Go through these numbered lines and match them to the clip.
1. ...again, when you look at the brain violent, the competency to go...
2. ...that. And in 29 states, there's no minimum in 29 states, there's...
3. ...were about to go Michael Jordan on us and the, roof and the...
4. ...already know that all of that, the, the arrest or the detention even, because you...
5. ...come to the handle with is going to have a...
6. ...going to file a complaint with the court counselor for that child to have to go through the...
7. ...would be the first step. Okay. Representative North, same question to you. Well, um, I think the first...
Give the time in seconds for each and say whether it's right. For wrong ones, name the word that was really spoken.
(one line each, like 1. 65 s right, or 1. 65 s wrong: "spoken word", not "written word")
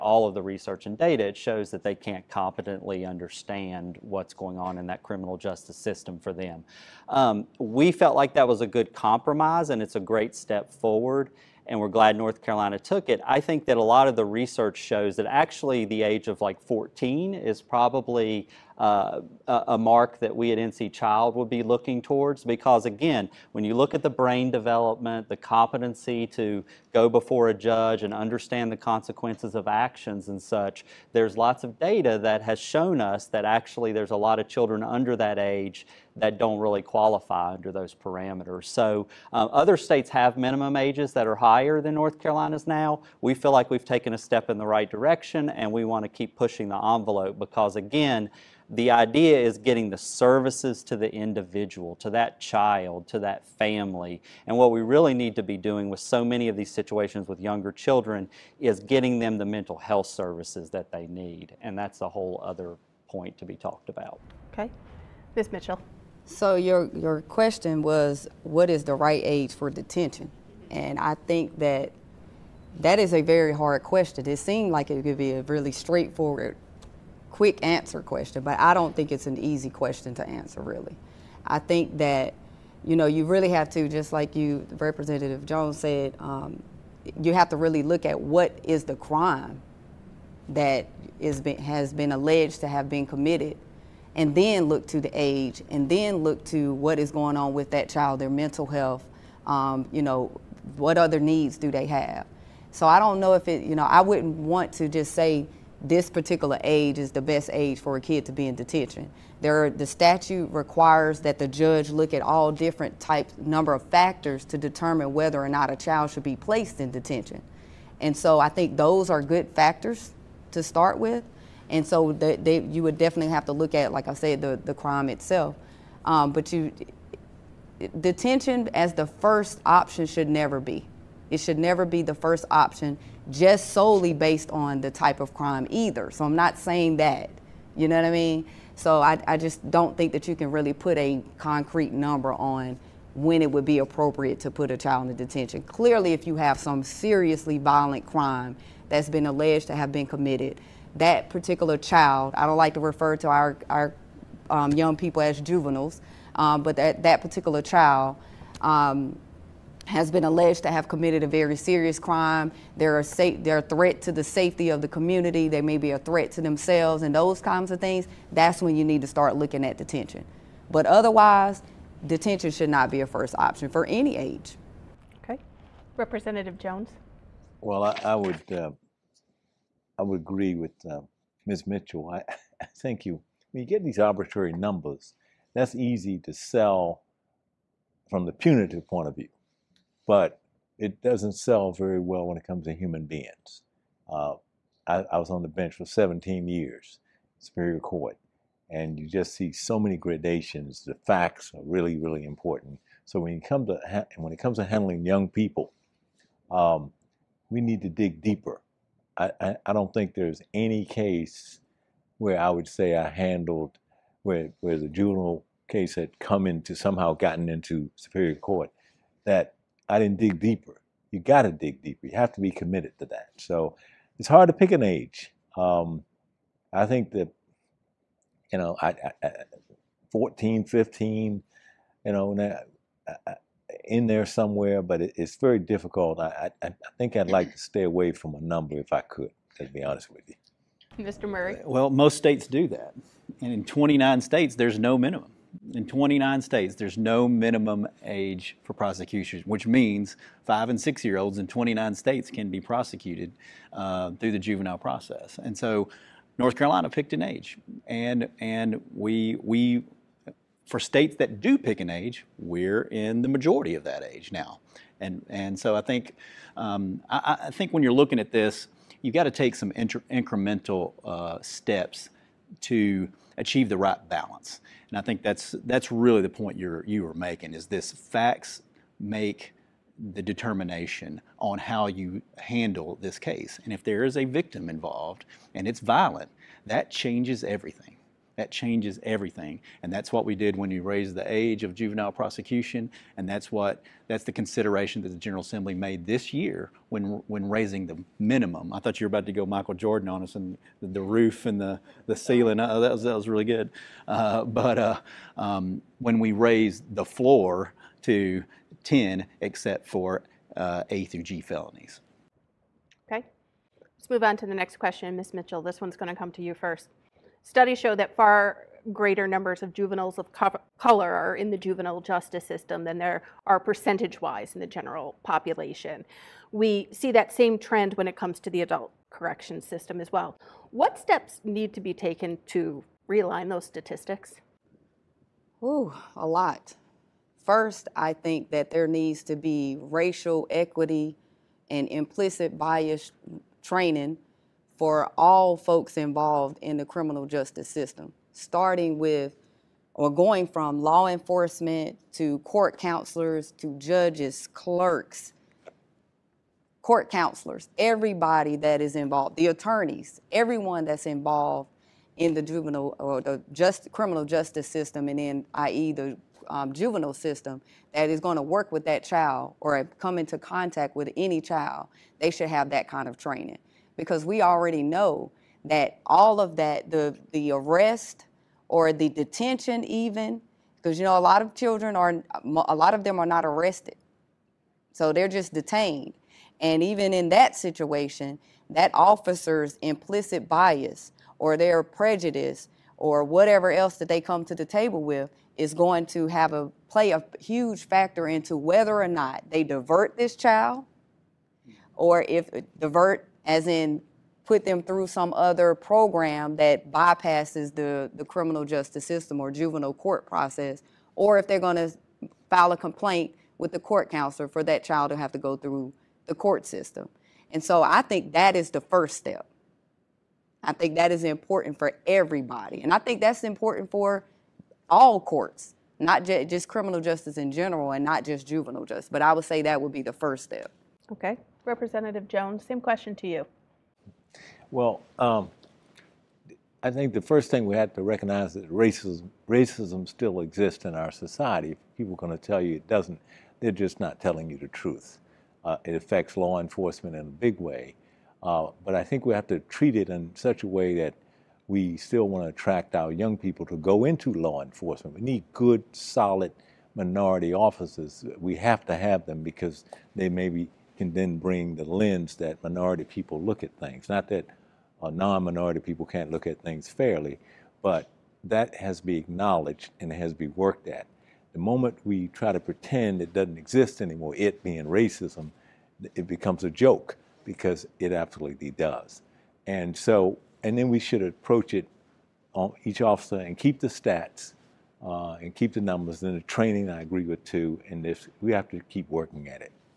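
1. 22 s wrong: "development", not "violent"
2. 242 s right
3. 299 s right
4. 374 s right
5. 394 s wrong: "table", not "handle"
6. 411 s right
7. 429 s wrong: "Jones", not "North".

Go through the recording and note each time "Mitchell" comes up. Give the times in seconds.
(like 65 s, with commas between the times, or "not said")
65 s, 181 s, 315 s.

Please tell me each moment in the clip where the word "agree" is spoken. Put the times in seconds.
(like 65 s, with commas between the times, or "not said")
180 s, 487 s.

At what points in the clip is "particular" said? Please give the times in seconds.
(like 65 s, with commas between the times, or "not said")
106 s, 151 s, 157 s.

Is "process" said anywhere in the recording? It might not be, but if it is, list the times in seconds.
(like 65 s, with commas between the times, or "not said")
254 s, 410 s.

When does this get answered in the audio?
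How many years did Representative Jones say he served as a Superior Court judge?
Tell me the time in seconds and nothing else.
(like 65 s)
195 s.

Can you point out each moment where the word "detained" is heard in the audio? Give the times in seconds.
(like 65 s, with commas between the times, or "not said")
385 s.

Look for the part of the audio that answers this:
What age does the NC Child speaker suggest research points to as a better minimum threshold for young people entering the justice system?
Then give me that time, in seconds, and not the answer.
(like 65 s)
15 s.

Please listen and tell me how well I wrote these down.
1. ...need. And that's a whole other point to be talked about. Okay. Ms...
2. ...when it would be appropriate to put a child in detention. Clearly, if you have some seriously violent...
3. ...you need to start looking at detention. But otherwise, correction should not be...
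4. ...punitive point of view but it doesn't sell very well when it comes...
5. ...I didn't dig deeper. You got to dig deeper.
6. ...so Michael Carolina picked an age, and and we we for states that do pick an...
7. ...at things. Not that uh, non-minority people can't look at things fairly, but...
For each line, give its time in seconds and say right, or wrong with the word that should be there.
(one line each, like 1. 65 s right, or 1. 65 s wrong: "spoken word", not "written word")
1. 61 s right
2. 143 s right
3. 168 s wrong: "detention", not "correction"
4. 188 s right
5. 219 s right
6. 255 s wrong: "North", not "Michael"
7. 463 s right.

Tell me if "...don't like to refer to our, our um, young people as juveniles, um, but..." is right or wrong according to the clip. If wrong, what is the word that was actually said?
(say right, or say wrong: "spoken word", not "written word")
right.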